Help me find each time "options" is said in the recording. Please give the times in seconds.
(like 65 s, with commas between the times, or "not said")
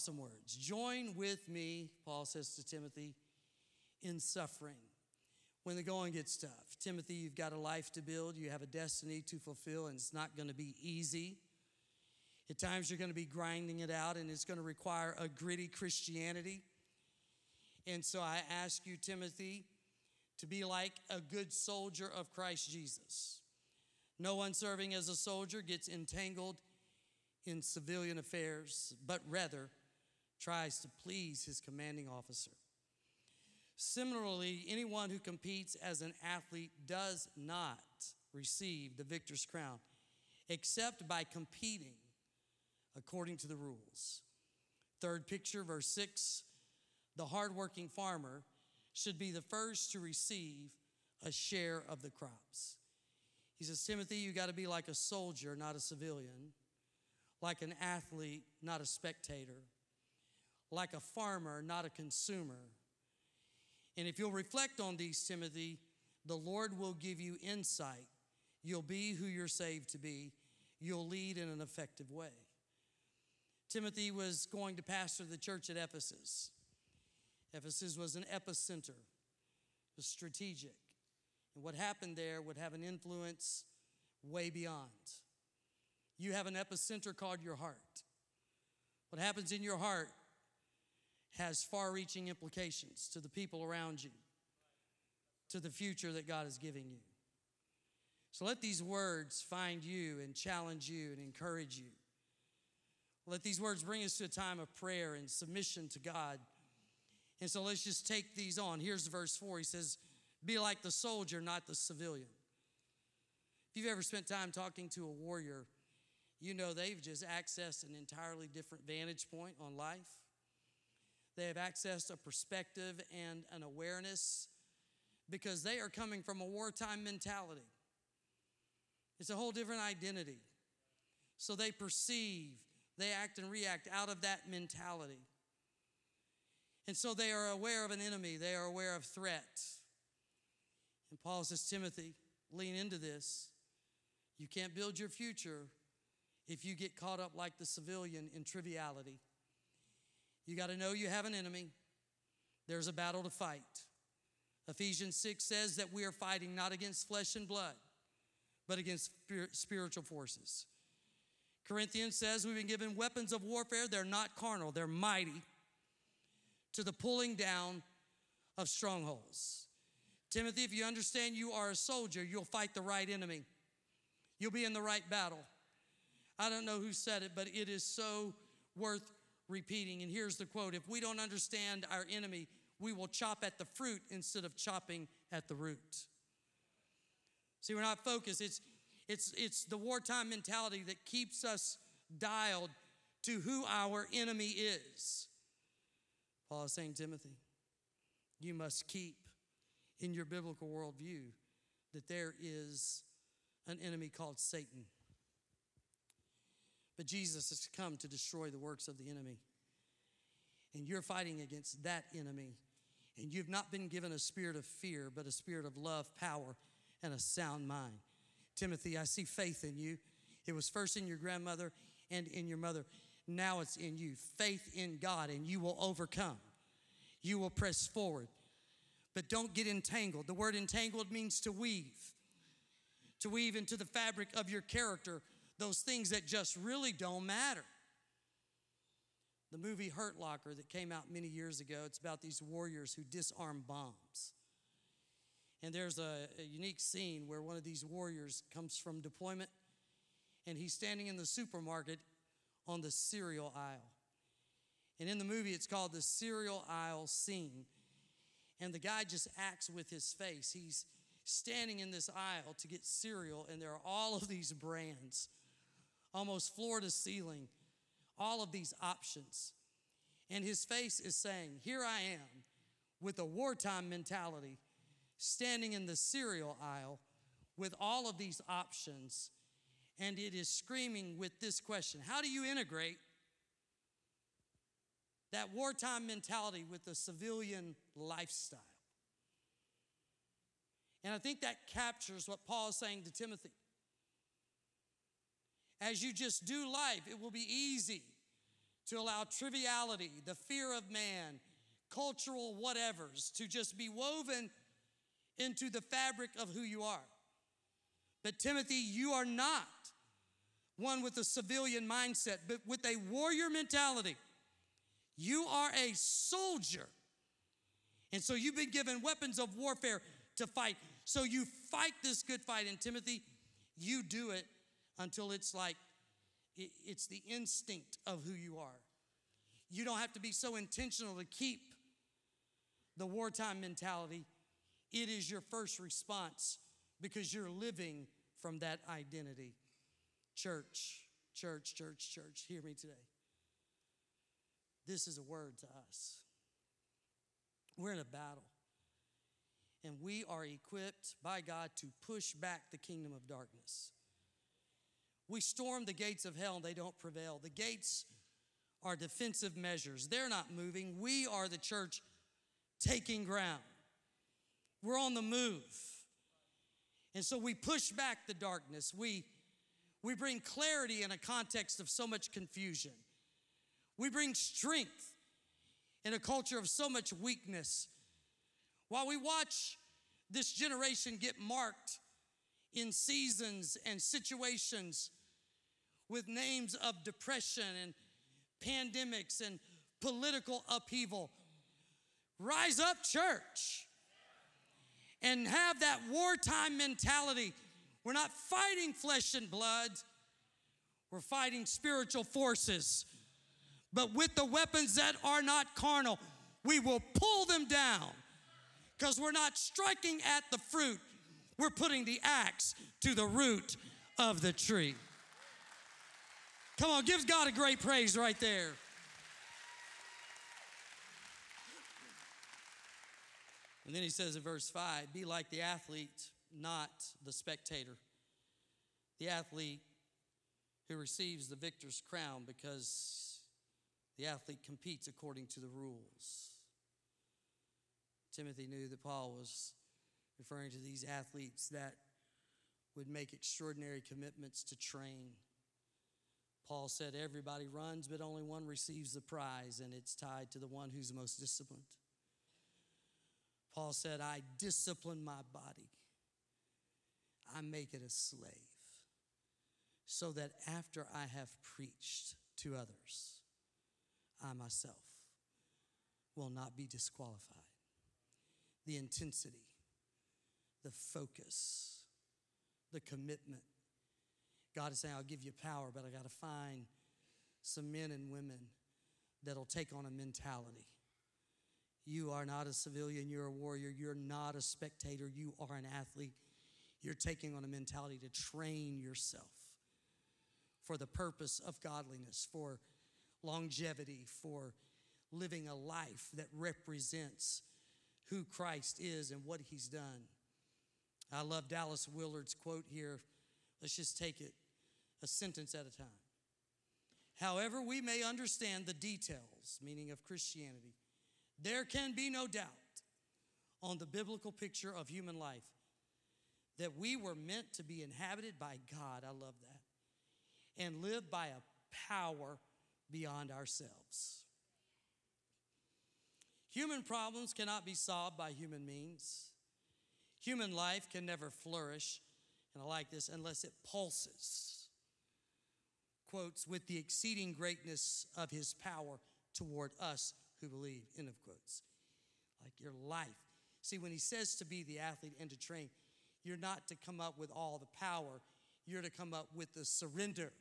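268 s, 278 s.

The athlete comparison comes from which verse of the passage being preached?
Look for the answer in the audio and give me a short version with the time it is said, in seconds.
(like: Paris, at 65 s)
verse 5, at 424 s.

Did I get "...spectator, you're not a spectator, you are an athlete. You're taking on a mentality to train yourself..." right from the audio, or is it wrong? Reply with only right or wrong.
wrong.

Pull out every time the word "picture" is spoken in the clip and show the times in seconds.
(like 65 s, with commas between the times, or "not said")
45 s, 514 s.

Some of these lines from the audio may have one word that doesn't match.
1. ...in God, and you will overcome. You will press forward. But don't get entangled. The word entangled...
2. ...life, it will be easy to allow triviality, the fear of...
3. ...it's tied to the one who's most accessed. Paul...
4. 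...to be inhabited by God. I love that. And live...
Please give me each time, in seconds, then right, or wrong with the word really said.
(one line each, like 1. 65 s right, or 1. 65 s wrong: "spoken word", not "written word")
1. 224 s right
2. 296 s right
3. 449 s wrong: "disciplined", not "accessed"
4. 517 s right.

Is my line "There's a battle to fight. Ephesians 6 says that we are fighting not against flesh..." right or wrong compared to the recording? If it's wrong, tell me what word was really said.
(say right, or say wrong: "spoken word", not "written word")
right.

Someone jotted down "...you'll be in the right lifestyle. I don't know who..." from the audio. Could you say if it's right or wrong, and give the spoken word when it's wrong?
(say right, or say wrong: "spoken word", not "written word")
wrong: "battle", not "lifestyle".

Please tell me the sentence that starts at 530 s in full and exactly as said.
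Human life can never flourish, and I like this, unless it pulses.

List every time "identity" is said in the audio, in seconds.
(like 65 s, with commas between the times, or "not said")
129 s, 338 s.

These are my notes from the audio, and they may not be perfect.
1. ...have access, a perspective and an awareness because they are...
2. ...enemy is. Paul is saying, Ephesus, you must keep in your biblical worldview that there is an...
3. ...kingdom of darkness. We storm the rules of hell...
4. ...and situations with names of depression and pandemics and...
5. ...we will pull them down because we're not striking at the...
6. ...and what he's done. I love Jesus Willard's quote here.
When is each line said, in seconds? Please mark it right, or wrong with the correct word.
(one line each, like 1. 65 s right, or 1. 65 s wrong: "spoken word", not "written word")
1. 121 s right
2. 194 s wrong: "Timothy", not "Ephesus"
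3. 352 s wrong: "gates", not "rules"
4. 383 s right
5. 406 s right
6. 499 s wrong: "Dallas", not "Jesus".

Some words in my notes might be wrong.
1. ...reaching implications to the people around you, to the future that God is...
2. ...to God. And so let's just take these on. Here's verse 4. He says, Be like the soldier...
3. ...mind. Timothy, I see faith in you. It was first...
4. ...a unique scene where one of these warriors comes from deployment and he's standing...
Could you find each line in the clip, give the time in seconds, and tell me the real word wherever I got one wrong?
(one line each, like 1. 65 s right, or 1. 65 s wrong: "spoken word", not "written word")
1. 91 s right
2. 105 s right
3. 217 s right
4. 246 s right.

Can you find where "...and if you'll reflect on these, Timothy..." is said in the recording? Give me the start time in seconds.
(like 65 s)
63 s.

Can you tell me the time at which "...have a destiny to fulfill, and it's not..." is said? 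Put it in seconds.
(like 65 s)
8 s.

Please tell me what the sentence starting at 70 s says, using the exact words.
You'll lead in an effective way.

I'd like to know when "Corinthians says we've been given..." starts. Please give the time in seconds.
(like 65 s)
161 s.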